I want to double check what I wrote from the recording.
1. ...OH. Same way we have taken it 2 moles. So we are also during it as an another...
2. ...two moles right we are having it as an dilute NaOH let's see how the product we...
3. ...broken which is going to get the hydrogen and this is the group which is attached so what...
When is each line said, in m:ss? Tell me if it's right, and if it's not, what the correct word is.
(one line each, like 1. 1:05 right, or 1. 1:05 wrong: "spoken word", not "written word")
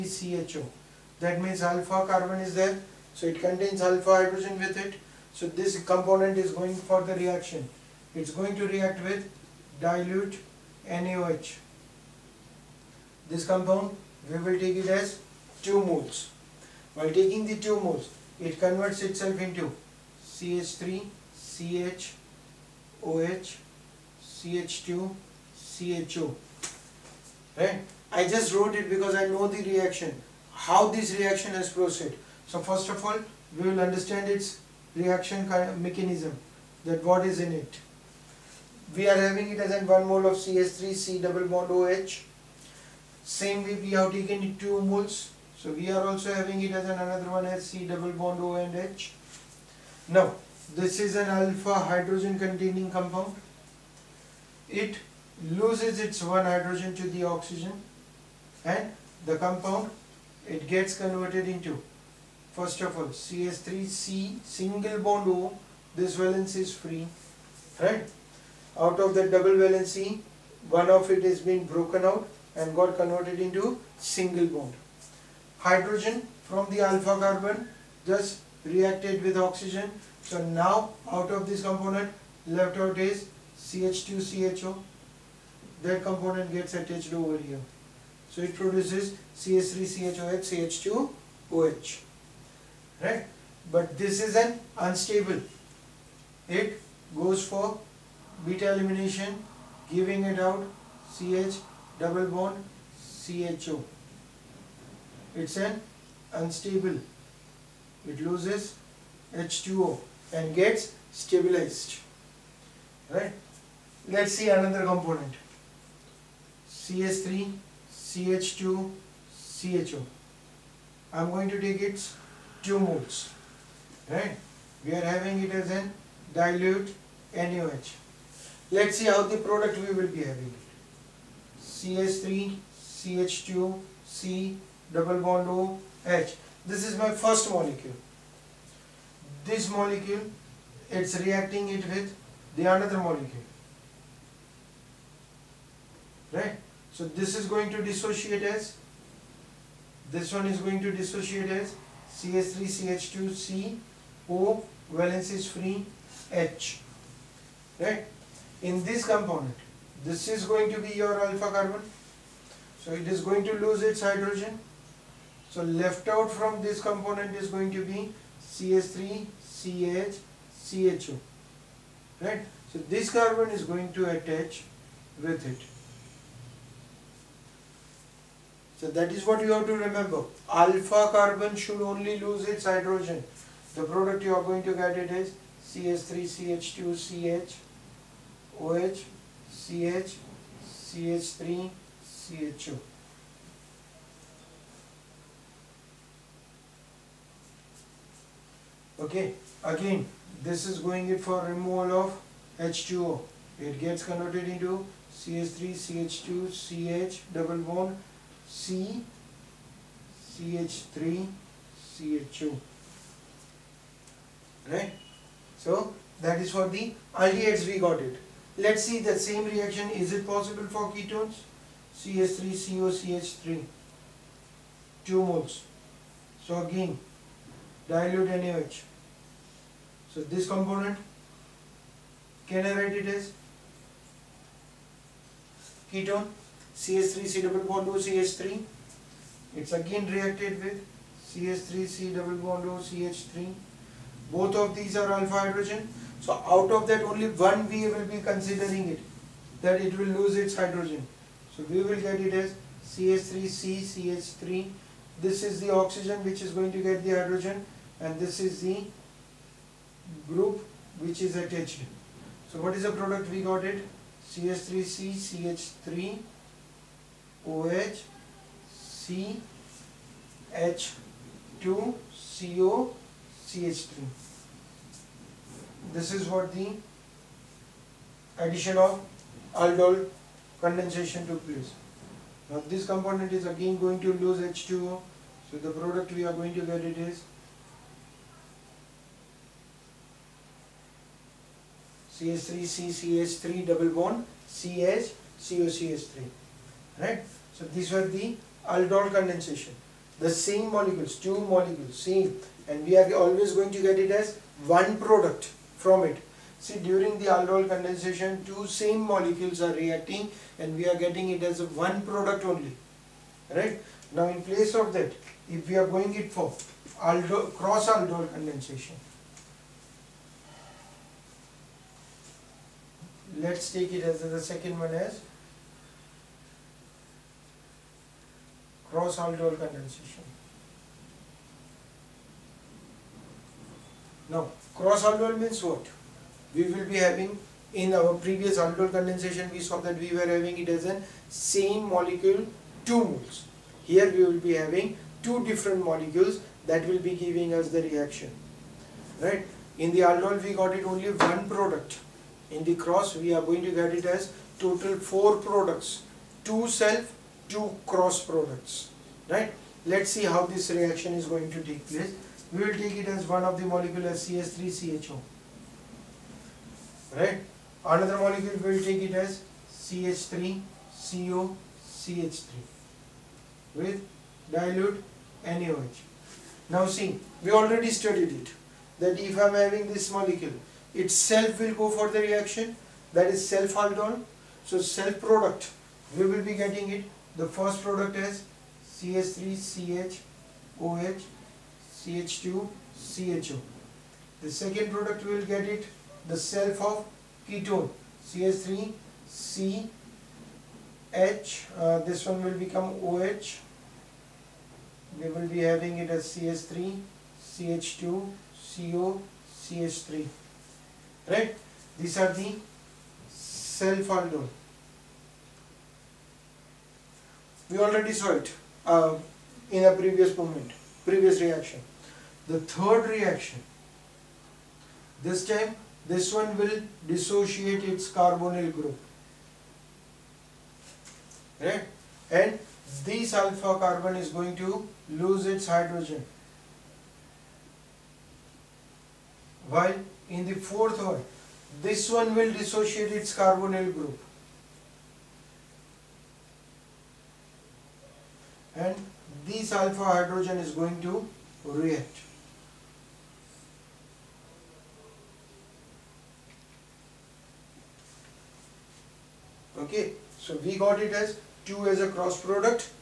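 1. 0:41 wrong: "having", not "during"
2. 2:02 right
3. 4:15 wrong: "oxygen", not "broken".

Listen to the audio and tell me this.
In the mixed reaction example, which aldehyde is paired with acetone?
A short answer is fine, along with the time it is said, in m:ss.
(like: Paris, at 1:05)
CH3CHO, at 6:04.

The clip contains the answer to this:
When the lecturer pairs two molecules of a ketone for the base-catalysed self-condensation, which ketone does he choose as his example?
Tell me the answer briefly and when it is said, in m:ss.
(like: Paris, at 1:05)
CH3COCH3, at 3:41.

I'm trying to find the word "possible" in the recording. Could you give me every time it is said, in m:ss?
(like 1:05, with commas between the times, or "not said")
3:40.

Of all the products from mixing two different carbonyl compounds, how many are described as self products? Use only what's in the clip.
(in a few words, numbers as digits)
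2.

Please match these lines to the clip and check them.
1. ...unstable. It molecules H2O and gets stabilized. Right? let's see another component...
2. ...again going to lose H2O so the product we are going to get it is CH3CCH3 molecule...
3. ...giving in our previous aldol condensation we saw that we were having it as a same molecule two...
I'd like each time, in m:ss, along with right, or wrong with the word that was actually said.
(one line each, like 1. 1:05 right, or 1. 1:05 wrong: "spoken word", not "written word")
1. 1:46 wrong: "loses", not "molecules"
2. 4:43 wrong: "double", not "molecule"
3. 5:36 wrong: "having", not "giving".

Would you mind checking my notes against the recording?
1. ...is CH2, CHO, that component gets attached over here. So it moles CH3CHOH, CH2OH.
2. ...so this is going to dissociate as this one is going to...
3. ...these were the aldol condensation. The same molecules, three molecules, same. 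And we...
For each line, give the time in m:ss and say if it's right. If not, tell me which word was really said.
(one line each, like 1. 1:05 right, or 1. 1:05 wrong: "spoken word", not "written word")
1. 1:22 wrong: "produces", not "moles"
2. 2:26 right
3. 4:57 wrong: "two", not "three".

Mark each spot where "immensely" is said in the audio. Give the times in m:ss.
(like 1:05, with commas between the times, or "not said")
not said.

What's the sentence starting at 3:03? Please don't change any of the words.
The product you are going to get it is CH3CH2CH OH CH CH3 CHO.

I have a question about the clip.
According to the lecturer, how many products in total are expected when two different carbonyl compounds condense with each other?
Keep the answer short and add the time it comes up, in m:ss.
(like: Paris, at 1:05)
4, at 5:55.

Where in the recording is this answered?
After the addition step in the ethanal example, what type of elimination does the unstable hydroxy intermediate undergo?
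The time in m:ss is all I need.
1:38.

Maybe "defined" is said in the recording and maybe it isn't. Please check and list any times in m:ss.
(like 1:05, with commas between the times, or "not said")
not said.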